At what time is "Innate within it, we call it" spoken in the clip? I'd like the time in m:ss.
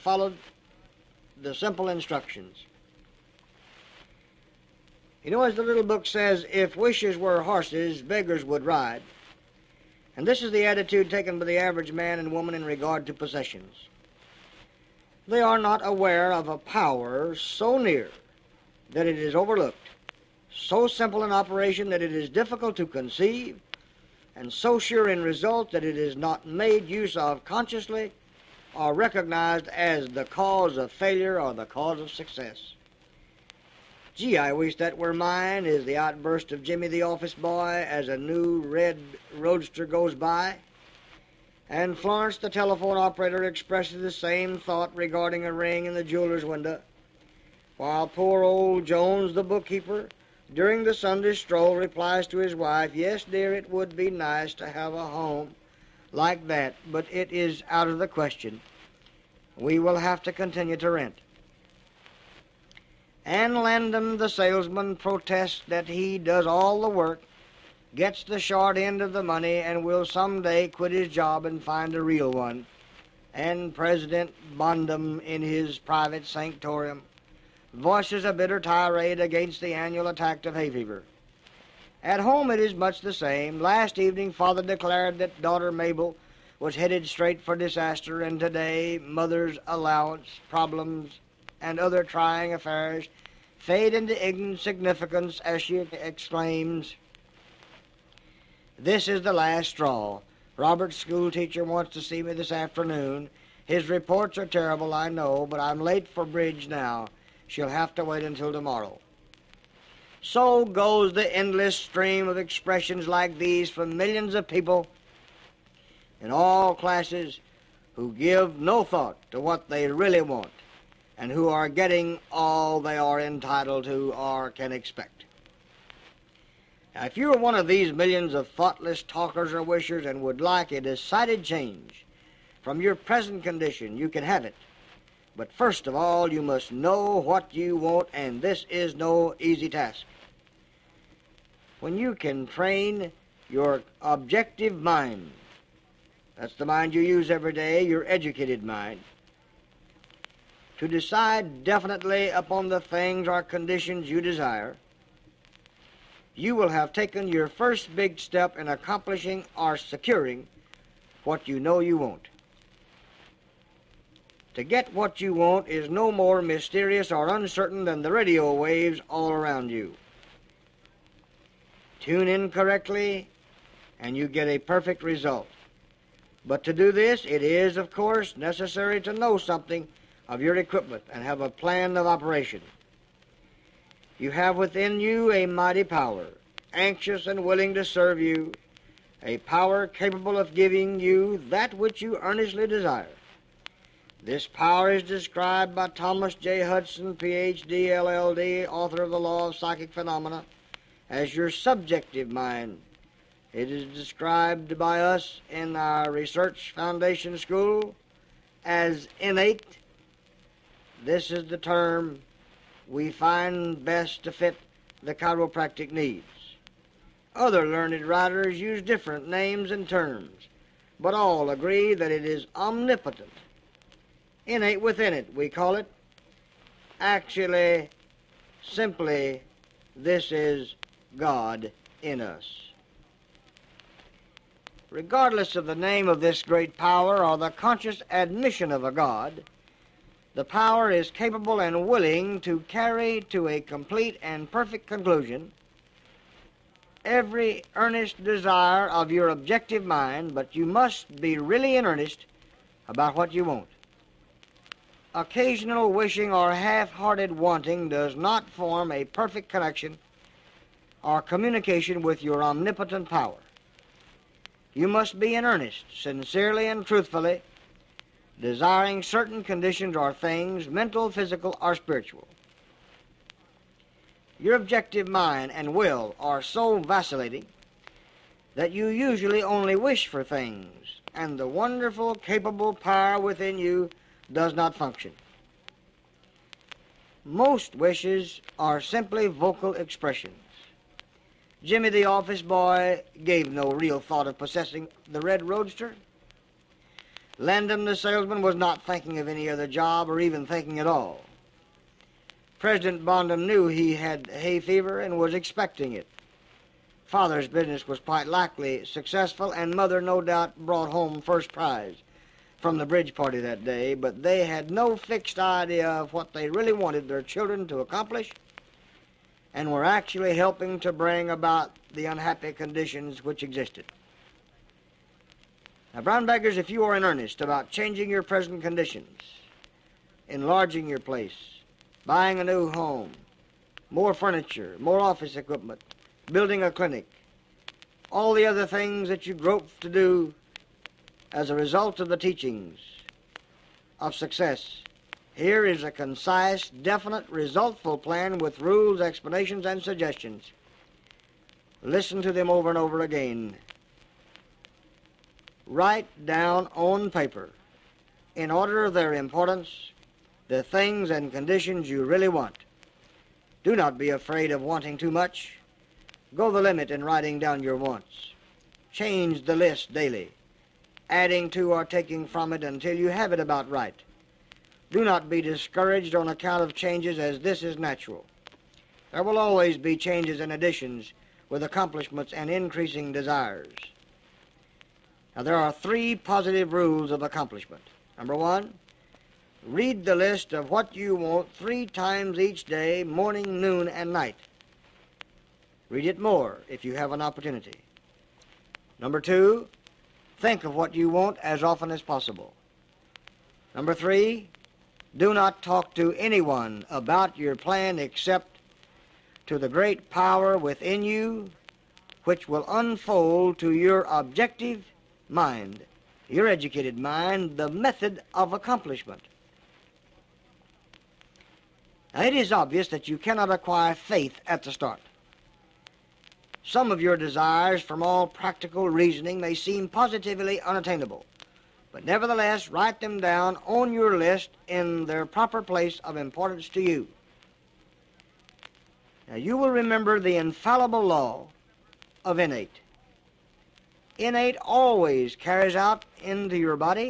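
3:44.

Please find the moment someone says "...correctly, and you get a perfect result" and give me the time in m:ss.
2:52.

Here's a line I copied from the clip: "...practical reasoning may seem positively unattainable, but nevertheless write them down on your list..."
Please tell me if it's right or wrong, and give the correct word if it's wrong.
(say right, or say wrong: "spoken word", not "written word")
right.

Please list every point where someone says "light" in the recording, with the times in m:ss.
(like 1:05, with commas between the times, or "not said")
not said.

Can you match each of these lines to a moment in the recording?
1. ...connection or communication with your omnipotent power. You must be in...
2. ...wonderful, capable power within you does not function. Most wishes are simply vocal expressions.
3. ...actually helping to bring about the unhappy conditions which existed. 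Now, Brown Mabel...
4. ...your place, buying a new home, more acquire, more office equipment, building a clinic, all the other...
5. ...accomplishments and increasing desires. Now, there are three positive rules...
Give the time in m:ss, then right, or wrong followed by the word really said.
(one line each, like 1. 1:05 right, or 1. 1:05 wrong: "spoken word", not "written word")
1. 4:19 right
2. 4:41 right
3. 5:19 wrong: "Baggers", not "Mabel"
4. 5:30 wrong: "furniture", not "acquire"
5. 6:21 right.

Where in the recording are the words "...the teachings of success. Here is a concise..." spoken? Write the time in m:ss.
5:42.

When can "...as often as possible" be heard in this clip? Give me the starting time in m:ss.
6:41.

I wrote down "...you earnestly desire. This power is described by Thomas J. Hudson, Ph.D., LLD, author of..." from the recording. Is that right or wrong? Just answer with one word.
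right.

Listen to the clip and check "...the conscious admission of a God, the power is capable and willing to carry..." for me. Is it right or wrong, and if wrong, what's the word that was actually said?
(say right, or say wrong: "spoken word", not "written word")
right.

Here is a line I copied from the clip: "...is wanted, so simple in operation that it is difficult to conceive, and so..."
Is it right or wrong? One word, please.
wrong.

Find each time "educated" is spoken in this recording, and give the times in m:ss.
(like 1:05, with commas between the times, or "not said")
2:28, 6:56.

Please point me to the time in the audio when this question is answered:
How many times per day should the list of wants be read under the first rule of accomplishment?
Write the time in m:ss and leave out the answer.
6:31.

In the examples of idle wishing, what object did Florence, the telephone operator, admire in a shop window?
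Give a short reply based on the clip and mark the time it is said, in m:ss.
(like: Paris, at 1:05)
A ring, at 0:45.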